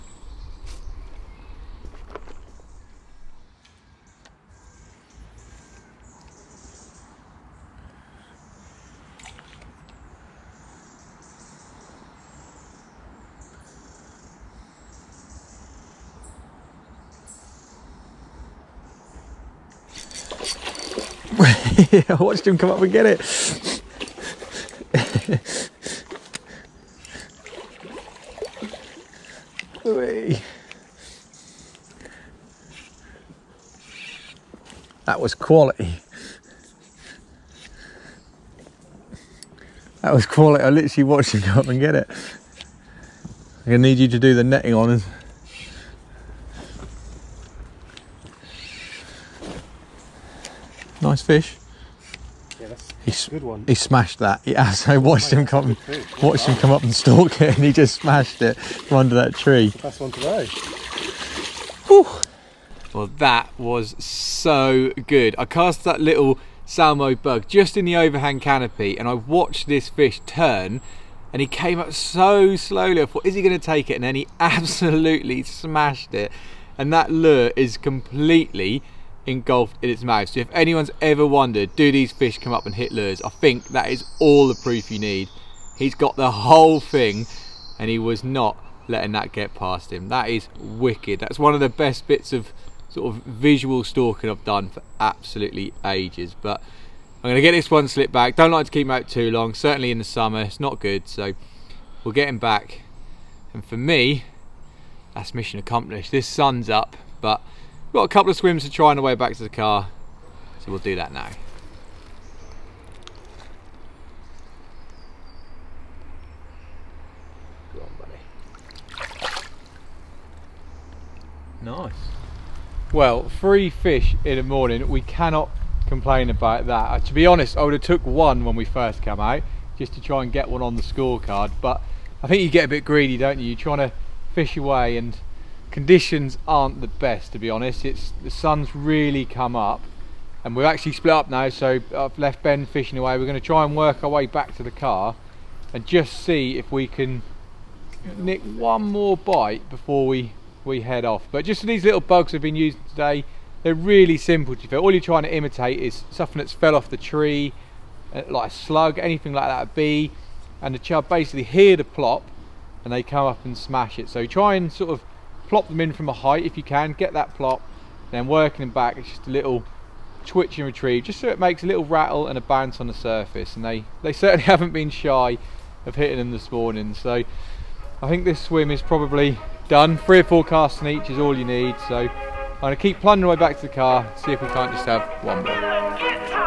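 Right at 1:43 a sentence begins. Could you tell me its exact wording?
And for me, that's mission accomplished.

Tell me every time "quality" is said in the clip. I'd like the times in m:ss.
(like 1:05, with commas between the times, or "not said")
0:35, 0:40.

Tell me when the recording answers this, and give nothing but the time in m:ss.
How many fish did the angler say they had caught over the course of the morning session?
2:03.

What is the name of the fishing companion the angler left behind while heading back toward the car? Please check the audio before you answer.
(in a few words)
Ben.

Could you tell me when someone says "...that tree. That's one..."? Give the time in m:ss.
0:59.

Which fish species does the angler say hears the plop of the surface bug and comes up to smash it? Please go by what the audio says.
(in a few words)
Chub.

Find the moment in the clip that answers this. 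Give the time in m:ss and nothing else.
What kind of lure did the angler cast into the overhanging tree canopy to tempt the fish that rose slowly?
1:06.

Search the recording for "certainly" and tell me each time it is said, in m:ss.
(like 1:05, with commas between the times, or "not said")
1:39, 2:54.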